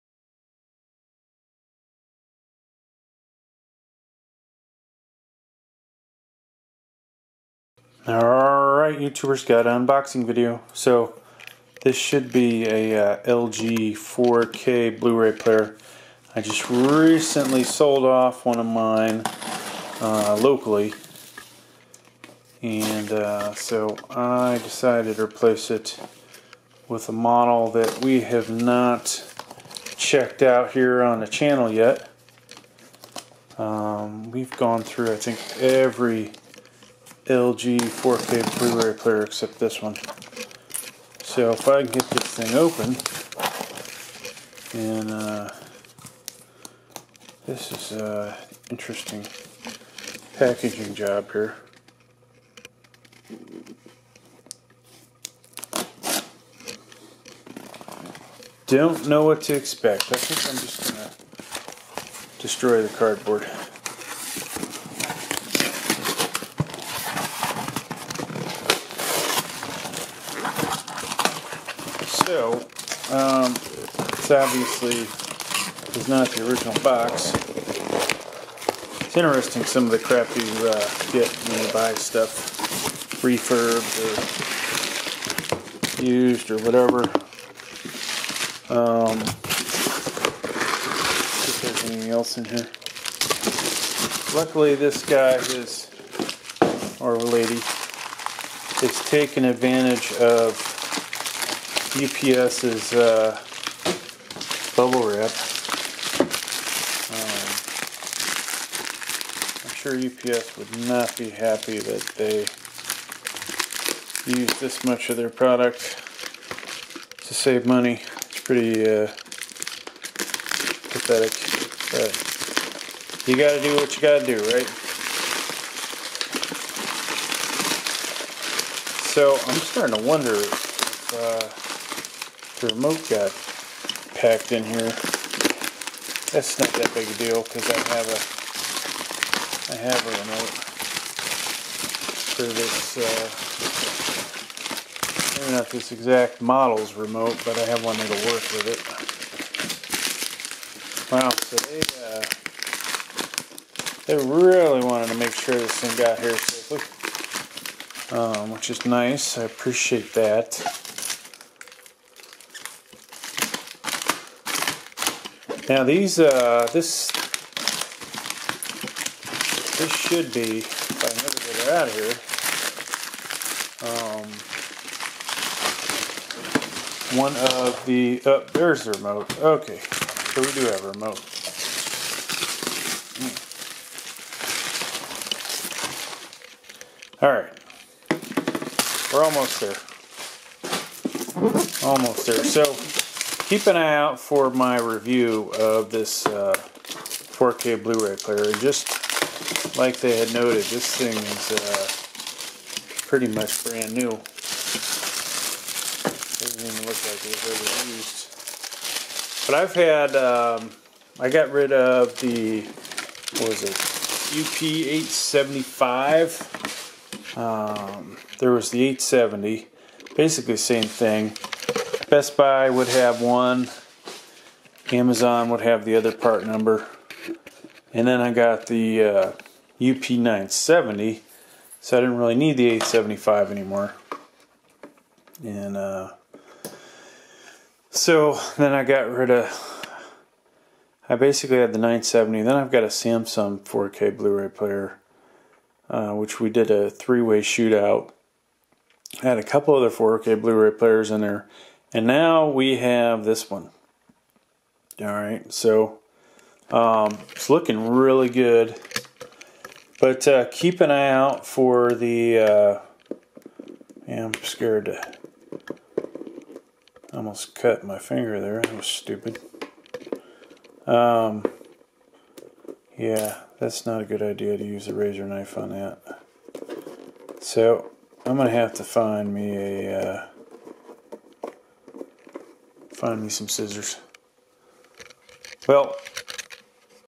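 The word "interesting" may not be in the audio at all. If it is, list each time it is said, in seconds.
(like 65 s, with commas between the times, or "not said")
48 s, 79 s.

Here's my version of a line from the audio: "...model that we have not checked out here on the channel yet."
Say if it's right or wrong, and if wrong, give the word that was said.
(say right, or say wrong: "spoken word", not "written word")
right.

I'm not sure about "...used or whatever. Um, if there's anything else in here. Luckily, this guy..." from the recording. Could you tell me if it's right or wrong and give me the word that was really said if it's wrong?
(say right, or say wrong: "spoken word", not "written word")
right.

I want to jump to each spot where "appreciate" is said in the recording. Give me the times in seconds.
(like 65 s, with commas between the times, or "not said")
159 s.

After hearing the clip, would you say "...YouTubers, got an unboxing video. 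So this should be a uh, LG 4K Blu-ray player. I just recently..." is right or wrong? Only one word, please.
right.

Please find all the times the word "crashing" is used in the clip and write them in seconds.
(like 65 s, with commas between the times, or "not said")
not said.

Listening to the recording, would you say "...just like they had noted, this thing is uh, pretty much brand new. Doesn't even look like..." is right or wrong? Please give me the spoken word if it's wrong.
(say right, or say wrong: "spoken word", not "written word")
right.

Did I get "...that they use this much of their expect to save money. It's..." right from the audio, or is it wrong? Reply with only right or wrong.
wrong.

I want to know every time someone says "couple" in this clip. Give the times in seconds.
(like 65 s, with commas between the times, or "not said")
249 s.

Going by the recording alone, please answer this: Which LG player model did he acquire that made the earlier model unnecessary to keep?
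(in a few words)
UP970.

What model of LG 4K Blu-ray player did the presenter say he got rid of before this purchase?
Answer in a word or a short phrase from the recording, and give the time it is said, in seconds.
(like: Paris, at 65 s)
UP875, at 214 s.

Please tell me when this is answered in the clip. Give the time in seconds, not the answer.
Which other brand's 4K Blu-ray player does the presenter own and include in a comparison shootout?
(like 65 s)
242 s.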